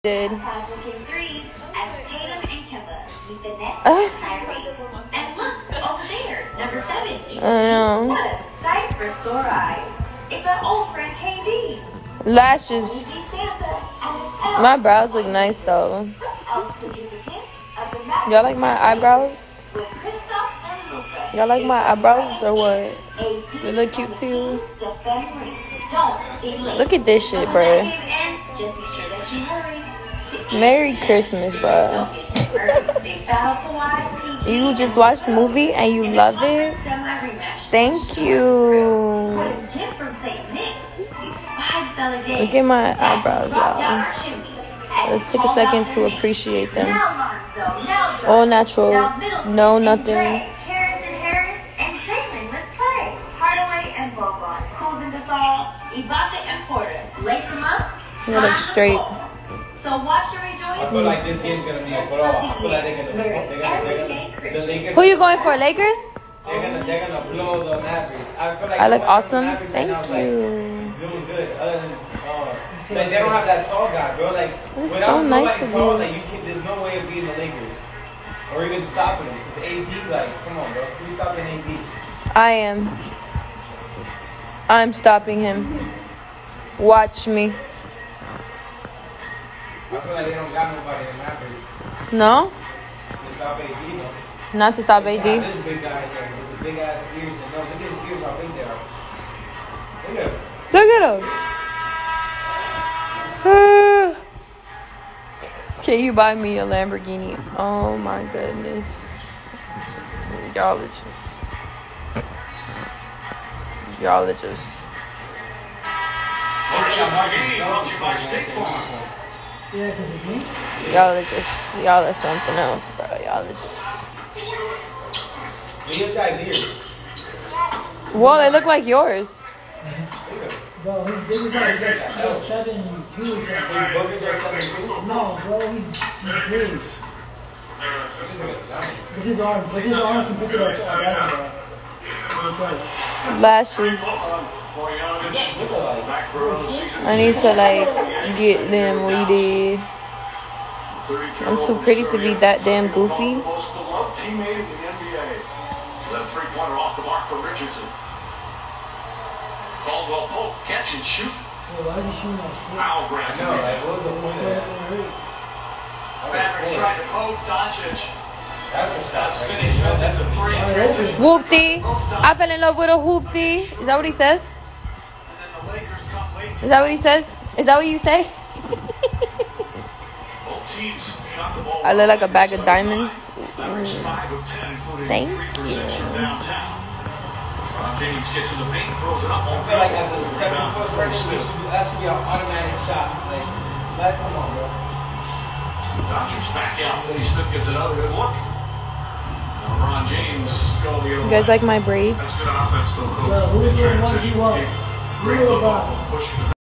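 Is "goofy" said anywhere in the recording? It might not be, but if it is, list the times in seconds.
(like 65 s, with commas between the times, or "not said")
152 s.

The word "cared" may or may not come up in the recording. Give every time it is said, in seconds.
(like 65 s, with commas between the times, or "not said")
not said.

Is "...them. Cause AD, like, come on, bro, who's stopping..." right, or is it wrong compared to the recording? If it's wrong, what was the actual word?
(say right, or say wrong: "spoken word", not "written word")
right.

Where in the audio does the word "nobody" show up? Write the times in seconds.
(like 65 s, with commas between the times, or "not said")
75 s.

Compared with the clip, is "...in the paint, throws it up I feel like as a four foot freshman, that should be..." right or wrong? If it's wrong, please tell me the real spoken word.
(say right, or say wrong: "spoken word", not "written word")
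wrong: "seven", not "four".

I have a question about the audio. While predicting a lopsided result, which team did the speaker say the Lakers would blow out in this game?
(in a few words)
Mavericks.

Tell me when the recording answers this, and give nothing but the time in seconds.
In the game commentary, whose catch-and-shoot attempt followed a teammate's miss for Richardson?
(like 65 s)
159 s.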